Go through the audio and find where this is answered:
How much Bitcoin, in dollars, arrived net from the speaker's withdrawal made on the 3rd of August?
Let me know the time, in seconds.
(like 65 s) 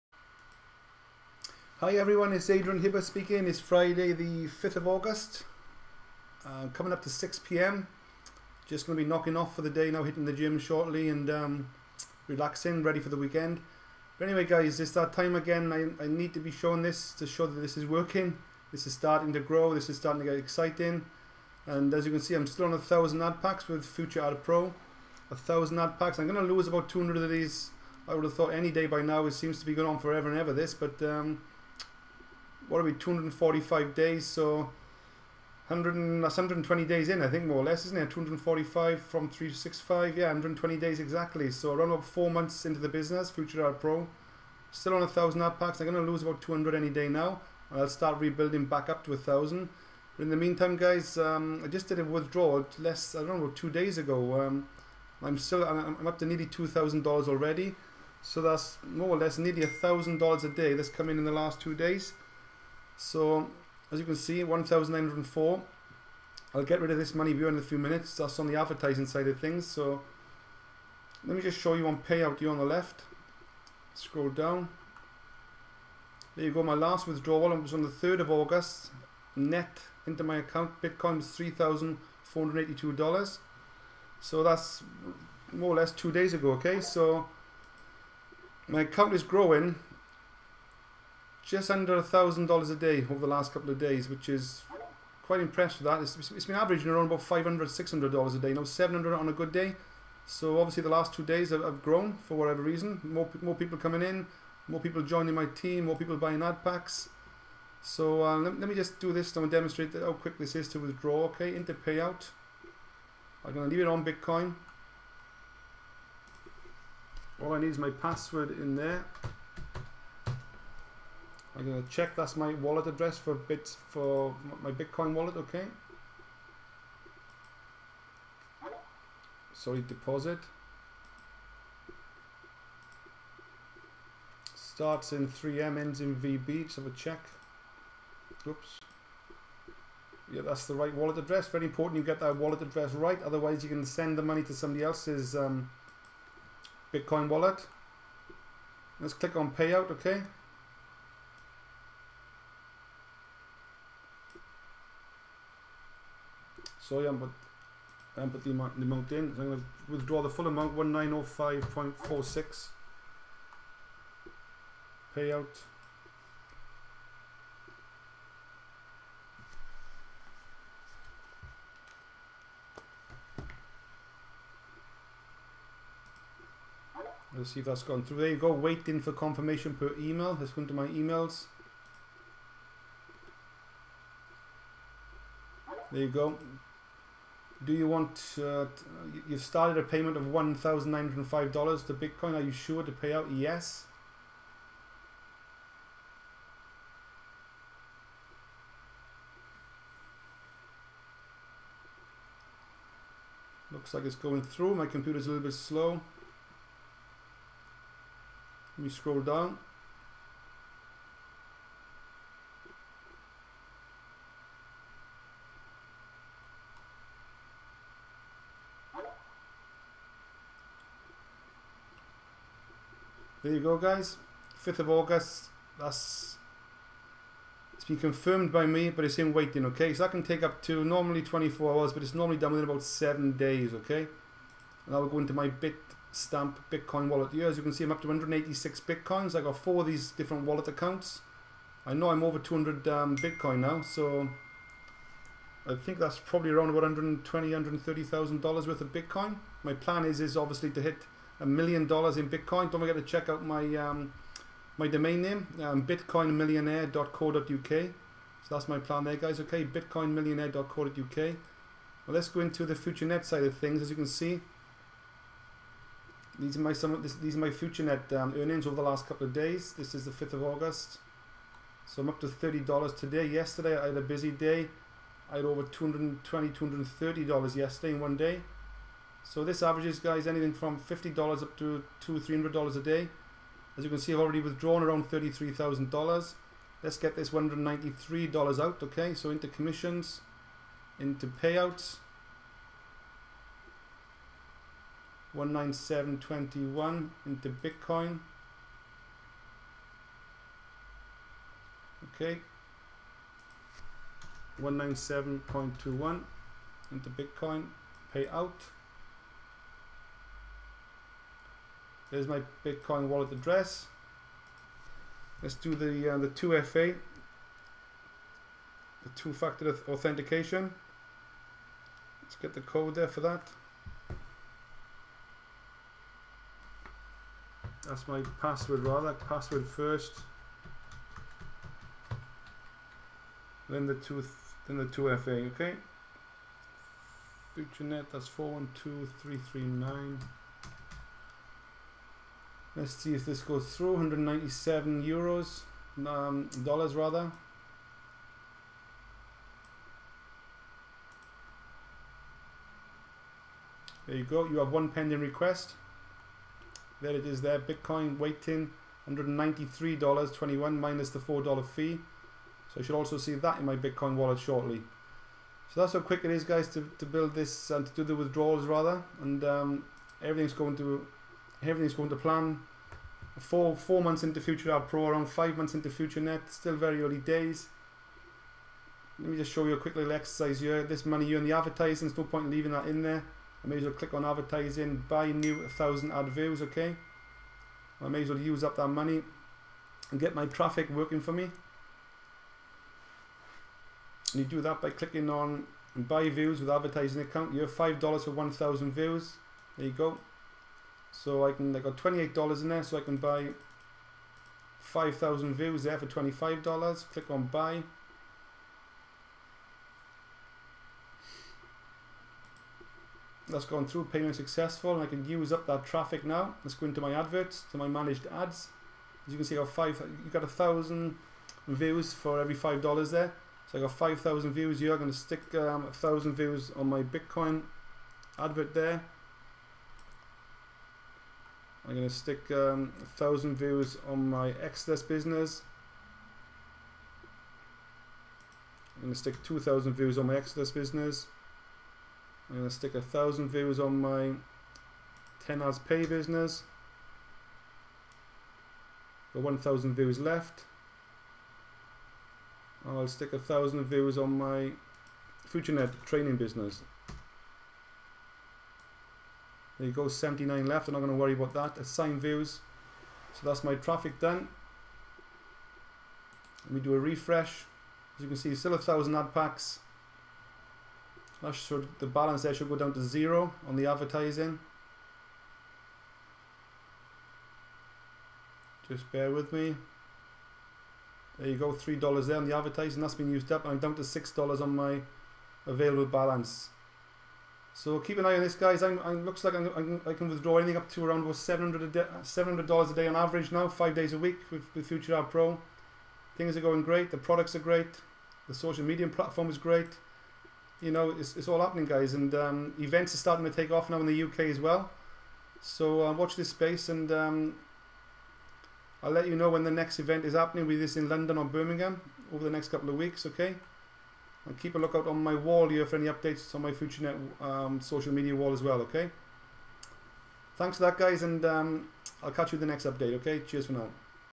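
81 s.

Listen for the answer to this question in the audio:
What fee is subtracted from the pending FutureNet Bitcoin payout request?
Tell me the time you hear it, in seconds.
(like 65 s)
361 s.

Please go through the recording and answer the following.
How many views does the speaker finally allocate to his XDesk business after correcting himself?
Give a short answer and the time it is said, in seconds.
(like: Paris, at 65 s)
2,000, at 439 s.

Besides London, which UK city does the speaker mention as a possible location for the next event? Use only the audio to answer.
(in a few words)
Birmingham.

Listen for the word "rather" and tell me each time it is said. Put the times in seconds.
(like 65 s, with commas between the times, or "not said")
328 s, 346 s, 368 s.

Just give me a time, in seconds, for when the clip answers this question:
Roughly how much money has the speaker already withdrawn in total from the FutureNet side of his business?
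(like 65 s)
285 s.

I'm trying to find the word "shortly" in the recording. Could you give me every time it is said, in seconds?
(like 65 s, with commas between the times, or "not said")
10 s, 364 s.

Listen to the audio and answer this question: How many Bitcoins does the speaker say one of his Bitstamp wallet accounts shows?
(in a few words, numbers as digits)
186.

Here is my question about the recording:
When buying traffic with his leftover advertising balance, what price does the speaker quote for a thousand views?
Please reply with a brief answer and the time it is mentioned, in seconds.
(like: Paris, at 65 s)
$5, at 397 s.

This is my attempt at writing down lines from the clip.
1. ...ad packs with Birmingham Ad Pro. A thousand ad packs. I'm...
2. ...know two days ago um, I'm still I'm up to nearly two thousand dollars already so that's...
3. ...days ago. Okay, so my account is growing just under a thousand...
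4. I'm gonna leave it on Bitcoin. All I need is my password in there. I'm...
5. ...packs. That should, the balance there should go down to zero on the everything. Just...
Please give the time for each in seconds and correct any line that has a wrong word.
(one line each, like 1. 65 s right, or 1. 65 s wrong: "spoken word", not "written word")
1. 23 s wrong: "Future", not "Birmingham"
2. 53 s right
3. 86 s right
4. 113 s right
5. 469 s wrong: "advertising", not "everything".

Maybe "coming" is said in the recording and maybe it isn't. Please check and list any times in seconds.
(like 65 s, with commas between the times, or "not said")
6 s, 103 s.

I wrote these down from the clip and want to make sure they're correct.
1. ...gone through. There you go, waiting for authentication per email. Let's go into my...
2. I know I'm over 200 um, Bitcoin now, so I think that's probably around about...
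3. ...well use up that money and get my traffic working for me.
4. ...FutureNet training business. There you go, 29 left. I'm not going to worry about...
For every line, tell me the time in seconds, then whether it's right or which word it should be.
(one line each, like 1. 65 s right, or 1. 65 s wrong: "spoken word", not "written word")
1. 177 s wrong: "confirmation", not "authentication"
2. 241 s right
3. 388 s right
4. 455 s wrong: "79", not "29".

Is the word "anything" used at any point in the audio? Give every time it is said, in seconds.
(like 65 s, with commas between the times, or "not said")
280 s, 490 s.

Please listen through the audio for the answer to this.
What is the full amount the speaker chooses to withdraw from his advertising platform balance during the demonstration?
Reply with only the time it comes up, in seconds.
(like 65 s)
160 s.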